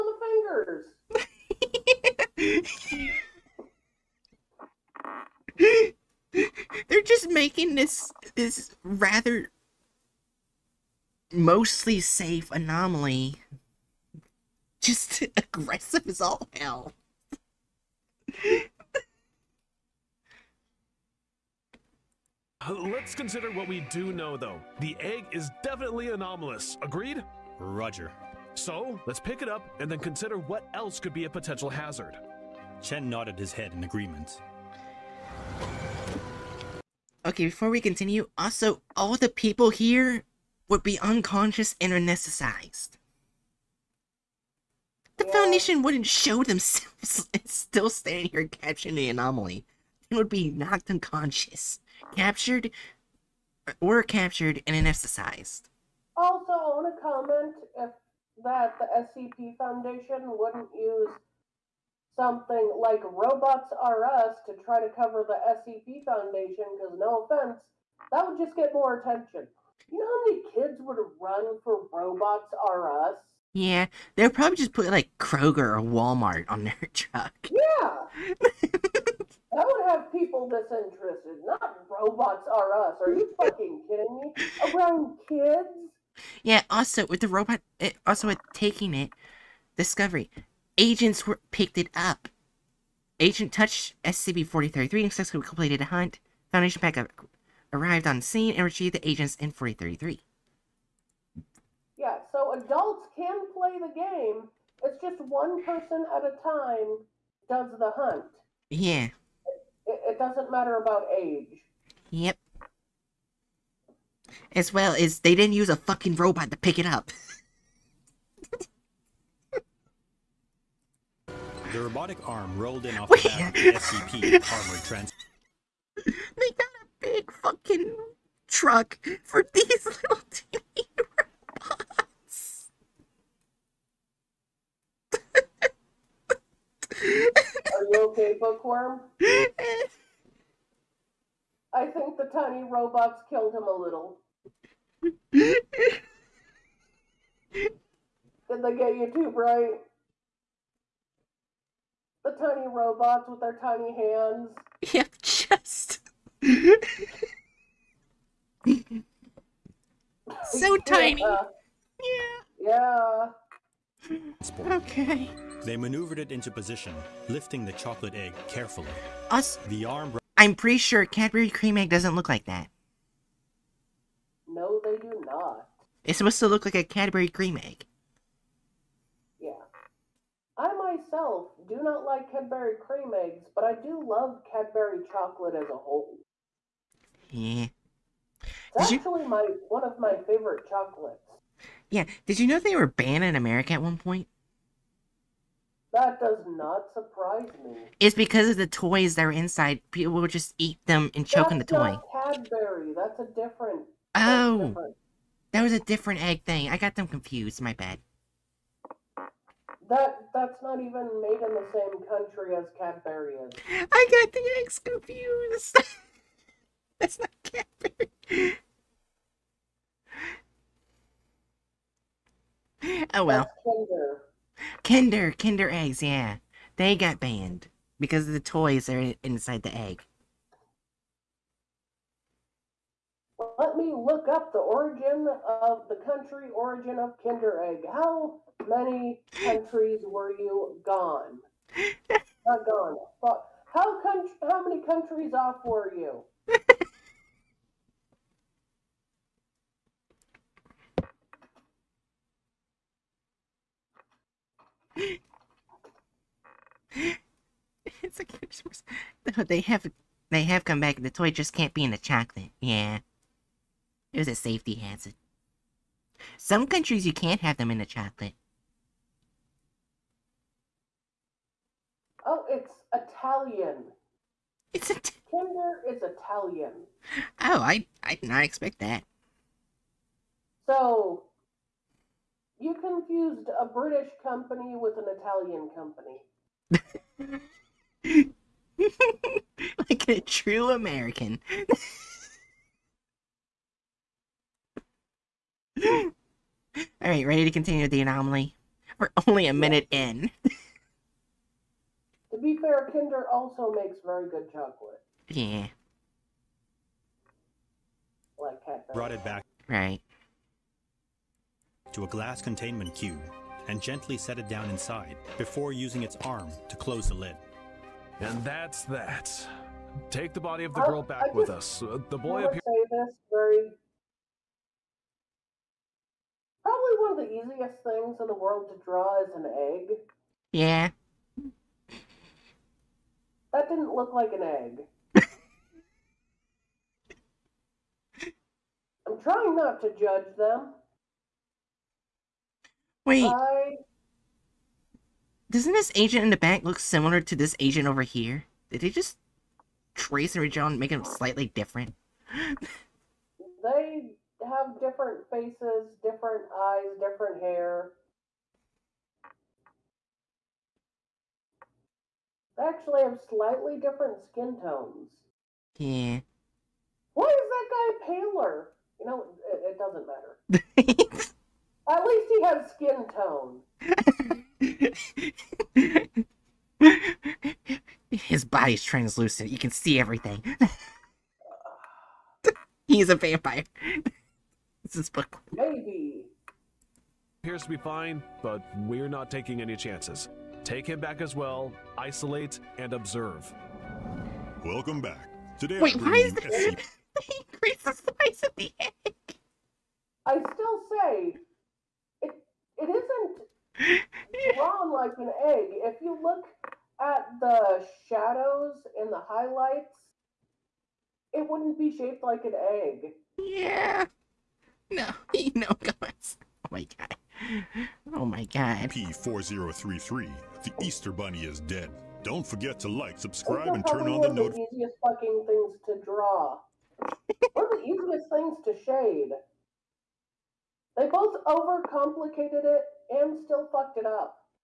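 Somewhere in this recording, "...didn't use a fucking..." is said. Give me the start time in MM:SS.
01:55.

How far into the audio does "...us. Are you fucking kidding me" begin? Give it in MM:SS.
01:22.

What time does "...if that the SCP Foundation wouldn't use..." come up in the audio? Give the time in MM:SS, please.
00:57.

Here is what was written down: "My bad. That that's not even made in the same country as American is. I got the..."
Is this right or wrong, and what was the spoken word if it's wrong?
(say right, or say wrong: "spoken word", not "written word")
wrong: "Cadbury", not "American".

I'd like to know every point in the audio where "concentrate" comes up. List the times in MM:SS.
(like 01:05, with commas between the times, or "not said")
not said.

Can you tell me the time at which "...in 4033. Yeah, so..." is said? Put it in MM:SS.
01:39.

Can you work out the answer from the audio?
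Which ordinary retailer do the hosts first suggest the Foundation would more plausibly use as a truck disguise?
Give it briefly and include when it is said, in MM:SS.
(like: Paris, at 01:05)
Kroger, at 01:15.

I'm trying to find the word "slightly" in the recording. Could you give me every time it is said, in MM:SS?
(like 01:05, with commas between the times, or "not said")
05:51, 06:03.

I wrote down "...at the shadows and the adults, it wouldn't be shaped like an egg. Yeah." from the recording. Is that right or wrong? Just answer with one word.
wrong.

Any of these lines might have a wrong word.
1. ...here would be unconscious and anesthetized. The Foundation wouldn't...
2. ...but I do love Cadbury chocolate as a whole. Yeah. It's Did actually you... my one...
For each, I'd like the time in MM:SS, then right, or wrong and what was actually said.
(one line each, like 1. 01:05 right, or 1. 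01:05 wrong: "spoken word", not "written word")
1. 00:39 right
2. 03:03 right.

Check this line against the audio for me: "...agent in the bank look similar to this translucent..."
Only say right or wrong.
wrong.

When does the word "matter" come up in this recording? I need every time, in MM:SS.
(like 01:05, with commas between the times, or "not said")
01:50, 06:10.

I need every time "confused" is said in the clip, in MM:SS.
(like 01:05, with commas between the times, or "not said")
03:27, 03:34, 04:42.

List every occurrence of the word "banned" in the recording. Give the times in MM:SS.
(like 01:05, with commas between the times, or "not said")
03:12, 03:47.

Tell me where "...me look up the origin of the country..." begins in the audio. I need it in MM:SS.
03:53.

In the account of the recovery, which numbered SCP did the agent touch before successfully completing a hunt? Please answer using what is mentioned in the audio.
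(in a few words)
SCP-4033.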